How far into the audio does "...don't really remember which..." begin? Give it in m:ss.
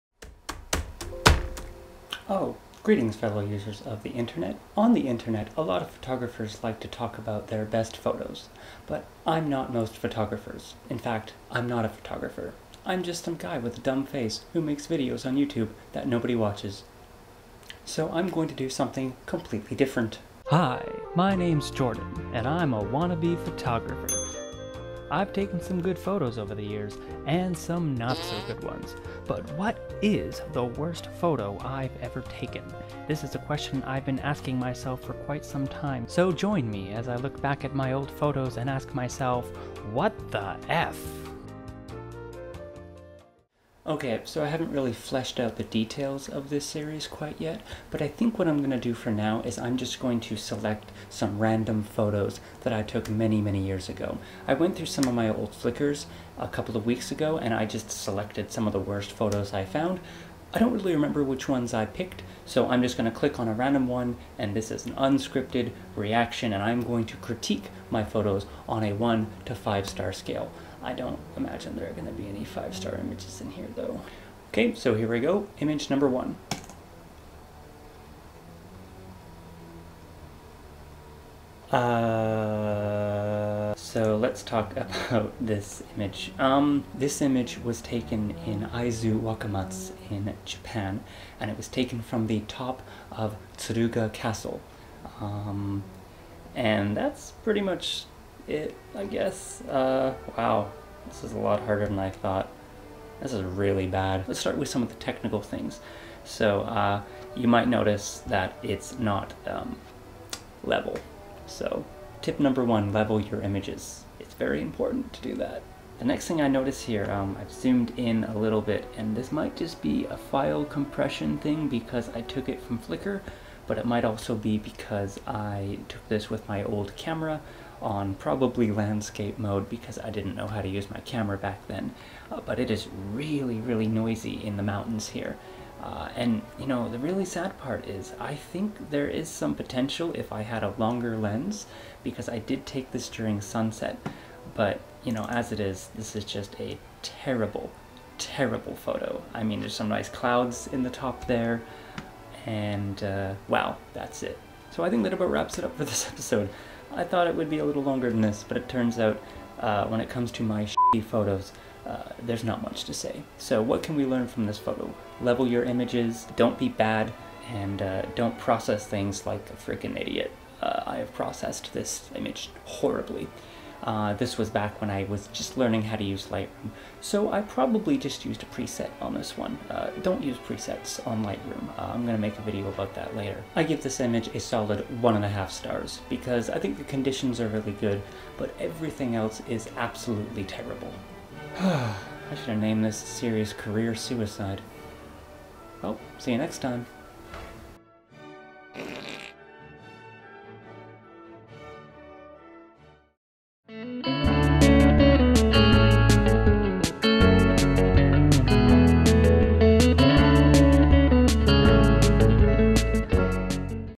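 1:00.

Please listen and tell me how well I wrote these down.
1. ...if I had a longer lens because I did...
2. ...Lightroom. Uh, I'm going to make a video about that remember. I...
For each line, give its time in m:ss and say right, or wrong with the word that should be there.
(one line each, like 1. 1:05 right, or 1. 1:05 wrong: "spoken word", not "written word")
1. 2:20 right
2. 3:01 wrong: "later", not "remember".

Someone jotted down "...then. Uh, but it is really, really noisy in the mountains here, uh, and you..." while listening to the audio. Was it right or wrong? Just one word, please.
right.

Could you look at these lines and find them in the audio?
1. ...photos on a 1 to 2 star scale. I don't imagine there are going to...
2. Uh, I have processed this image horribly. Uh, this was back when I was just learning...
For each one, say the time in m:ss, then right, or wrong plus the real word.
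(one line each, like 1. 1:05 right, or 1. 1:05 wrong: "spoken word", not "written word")
1. 1:08 wrong: "5", not "2"
2. 2:50 right.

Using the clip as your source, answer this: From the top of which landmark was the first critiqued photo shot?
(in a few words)
Tsuruga Castle.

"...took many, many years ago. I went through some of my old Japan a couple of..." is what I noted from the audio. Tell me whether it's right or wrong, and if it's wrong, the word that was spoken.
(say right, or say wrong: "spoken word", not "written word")
wrong: "Flickrs", not "Japan".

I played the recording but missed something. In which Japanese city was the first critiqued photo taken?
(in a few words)
Aizu Wakamatsu.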